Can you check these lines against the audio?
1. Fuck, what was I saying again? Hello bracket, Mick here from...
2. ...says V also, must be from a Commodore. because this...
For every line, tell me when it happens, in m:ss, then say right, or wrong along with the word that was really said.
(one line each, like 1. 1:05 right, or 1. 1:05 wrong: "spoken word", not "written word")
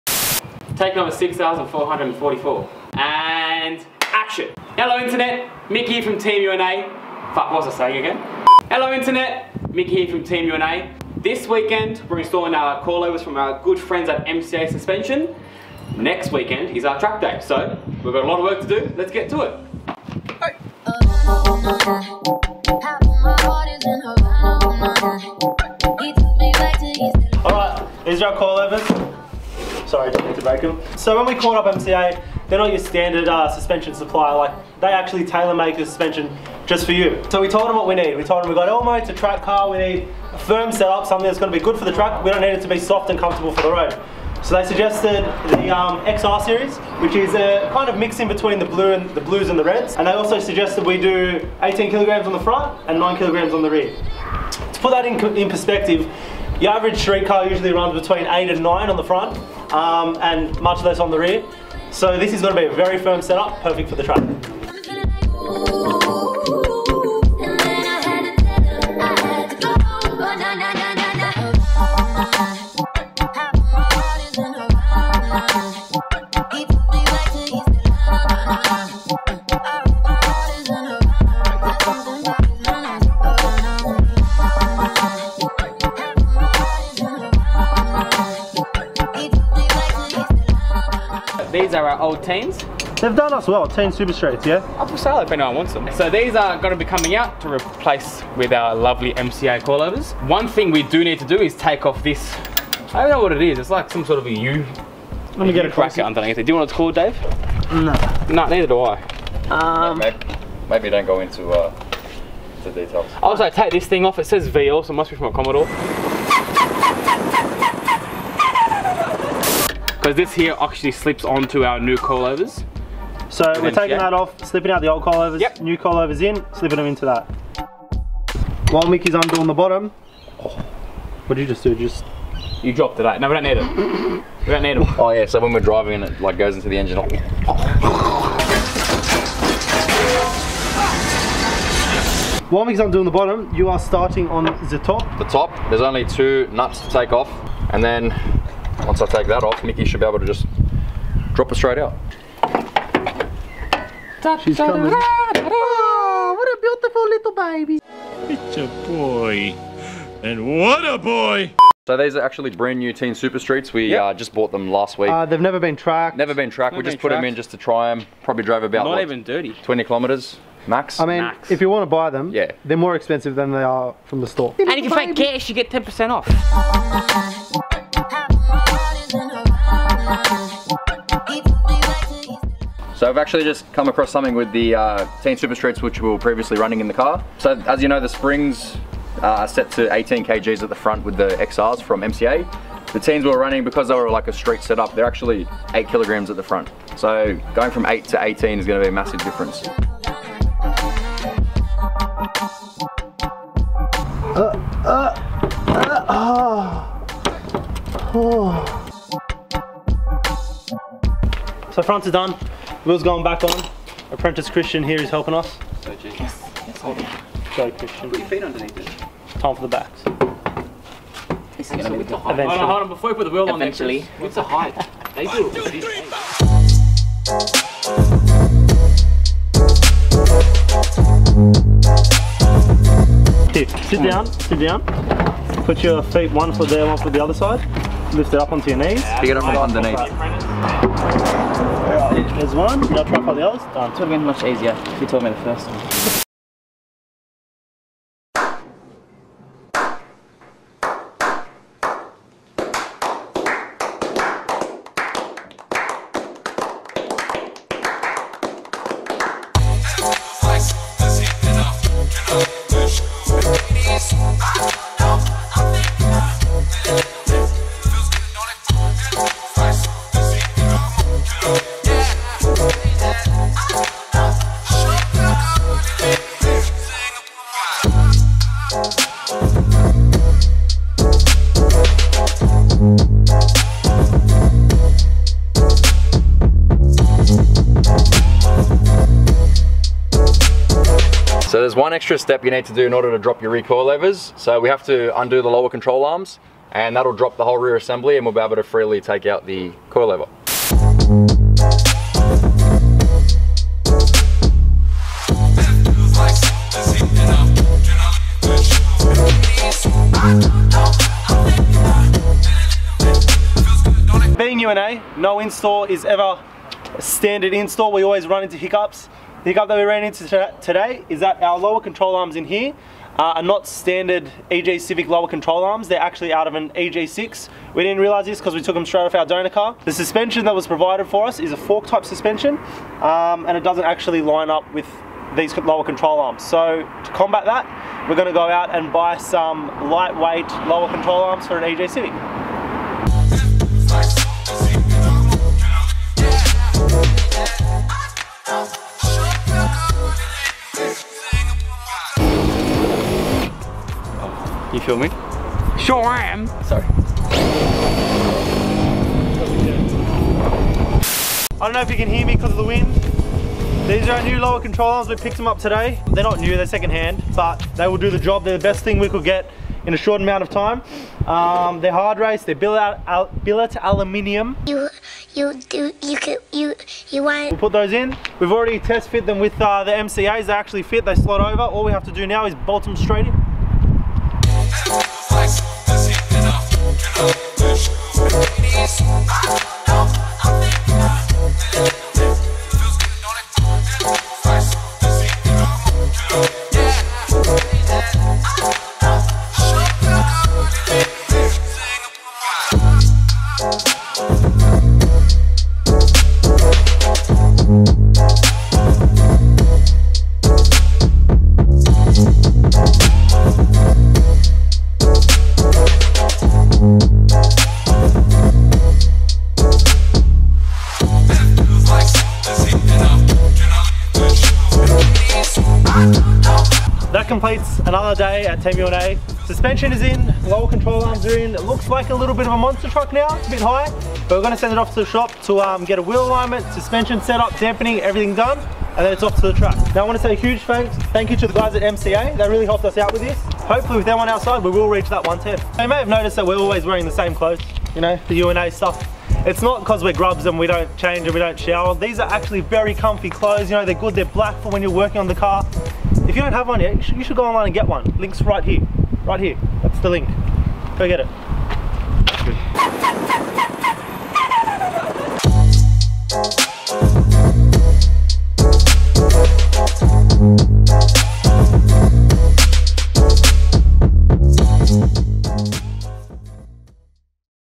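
1. 0:07 wrong: "internet", not "bracket"
2. 1:54 right.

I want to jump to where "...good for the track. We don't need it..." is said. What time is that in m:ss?
0:41.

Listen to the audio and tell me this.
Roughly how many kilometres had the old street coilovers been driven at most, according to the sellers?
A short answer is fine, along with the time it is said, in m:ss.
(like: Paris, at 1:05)
20 kilometers, at 2:49.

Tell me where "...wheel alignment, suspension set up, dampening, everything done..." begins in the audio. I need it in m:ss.
7:16.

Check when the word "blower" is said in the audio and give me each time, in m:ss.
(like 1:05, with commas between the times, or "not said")
not said.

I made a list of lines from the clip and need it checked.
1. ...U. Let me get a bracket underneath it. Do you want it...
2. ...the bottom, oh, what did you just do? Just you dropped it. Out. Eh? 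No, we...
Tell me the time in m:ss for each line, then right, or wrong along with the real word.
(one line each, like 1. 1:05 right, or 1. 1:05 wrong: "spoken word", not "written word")
1. 1:44 right
2. 2:09 right.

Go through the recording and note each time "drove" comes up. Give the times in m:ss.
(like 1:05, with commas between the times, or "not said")
2:48.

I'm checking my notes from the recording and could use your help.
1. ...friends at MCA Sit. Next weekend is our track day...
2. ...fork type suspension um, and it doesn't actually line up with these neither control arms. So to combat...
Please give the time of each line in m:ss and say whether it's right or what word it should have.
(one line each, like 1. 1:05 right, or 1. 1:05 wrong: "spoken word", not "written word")
1. 0:13 wrong: "Suspension", not "Sit"
2. 5:31 wrong: "lower", not "neither".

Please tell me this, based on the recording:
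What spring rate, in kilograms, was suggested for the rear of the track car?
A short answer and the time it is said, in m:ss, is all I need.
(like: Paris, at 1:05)
9 kilograms, at 0:52.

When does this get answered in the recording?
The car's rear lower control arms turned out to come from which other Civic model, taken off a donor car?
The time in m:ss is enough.
5:26.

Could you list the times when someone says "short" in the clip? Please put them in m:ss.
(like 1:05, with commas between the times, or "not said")
6:09.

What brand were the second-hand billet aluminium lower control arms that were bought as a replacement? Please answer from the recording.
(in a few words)
Hardrace.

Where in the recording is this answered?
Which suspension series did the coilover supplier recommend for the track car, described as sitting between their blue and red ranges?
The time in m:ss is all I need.
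0:46.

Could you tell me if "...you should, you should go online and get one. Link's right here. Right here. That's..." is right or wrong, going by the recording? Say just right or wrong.
right.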